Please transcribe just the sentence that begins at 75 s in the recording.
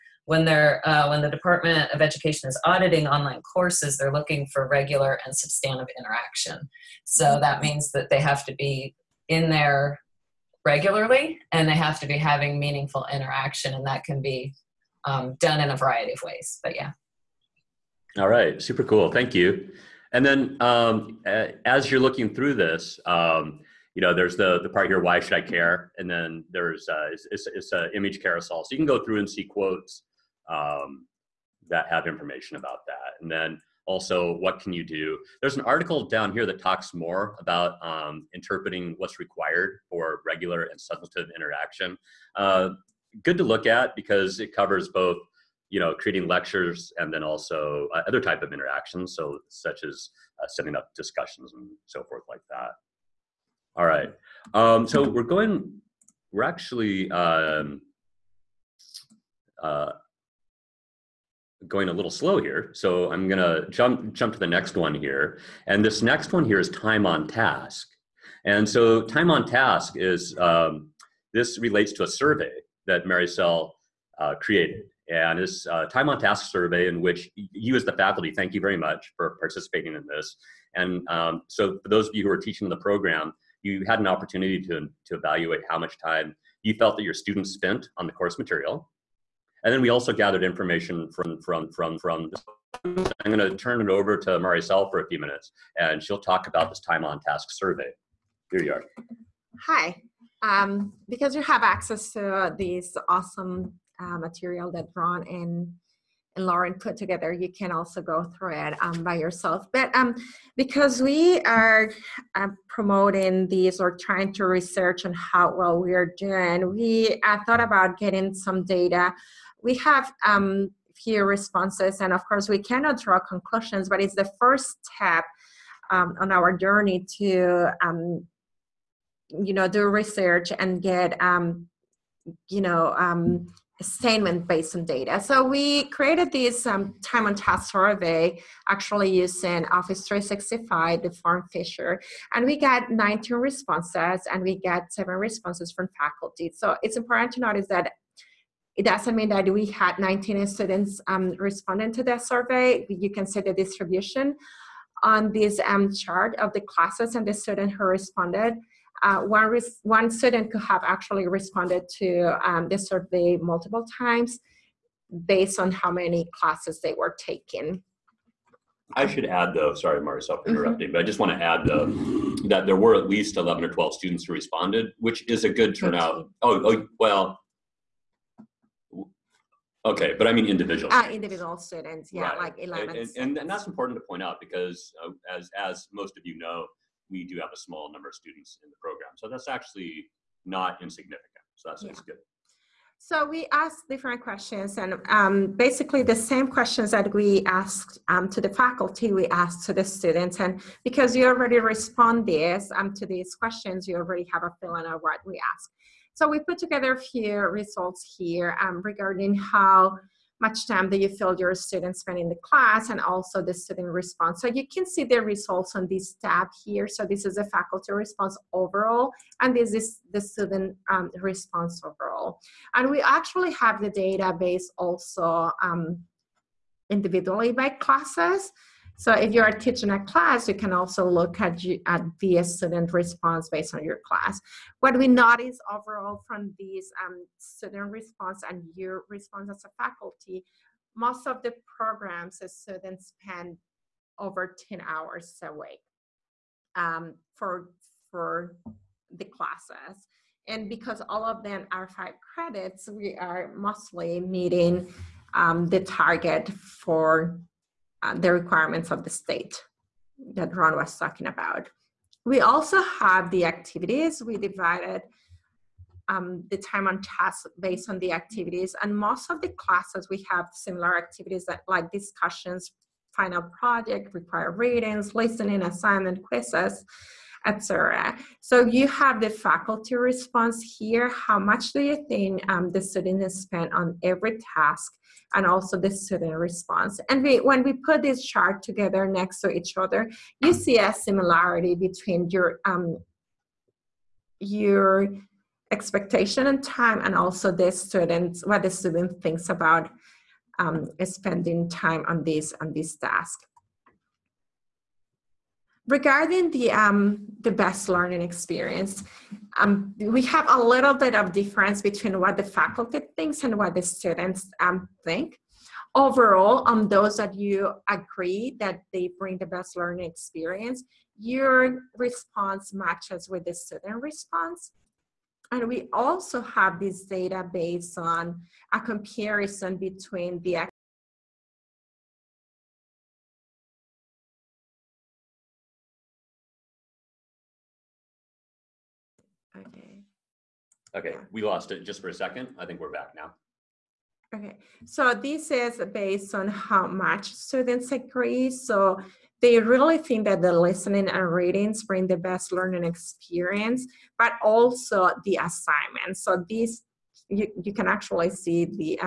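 And this a uh, time on task survey in which you as the faculty, thank you very much for participating in this.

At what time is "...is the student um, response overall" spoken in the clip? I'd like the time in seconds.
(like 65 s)
219 s.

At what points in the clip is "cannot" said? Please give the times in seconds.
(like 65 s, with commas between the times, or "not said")
122 s.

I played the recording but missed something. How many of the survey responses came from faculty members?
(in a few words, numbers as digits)
7.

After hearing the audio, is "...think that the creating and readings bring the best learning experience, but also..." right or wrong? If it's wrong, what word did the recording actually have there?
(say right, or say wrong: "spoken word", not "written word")
wrong: "listening", not "creating".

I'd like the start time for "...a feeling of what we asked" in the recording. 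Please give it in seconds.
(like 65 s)
204 s.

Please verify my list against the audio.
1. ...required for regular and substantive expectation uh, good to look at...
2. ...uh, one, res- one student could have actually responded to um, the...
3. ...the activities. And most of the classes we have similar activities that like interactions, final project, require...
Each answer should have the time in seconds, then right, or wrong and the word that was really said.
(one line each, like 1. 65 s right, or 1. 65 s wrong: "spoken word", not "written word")
1. 39 s wrong: "interaction", not "expectation"
2. 159 s right
3. 267 s wrong: "discussions", not "interactions".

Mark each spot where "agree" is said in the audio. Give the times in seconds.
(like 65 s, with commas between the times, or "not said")
317 s, 347 s.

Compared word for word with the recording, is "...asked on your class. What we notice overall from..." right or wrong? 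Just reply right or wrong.
wrong.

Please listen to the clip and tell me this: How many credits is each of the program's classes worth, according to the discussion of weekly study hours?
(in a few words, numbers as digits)
5.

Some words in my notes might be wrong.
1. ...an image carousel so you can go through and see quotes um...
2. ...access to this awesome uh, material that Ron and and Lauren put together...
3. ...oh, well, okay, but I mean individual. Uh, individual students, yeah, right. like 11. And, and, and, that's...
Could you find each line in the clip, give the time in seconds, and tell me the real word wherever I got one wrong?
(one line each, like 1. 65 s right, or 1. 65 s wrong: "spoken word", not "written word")
1. 27 s right
2. 101 s right
3. 176 s right.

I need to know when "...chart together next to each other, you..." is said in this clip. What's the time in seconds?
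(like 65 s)
288 s.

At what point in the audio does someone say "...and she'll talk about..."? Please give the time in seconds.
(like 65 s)
95 s.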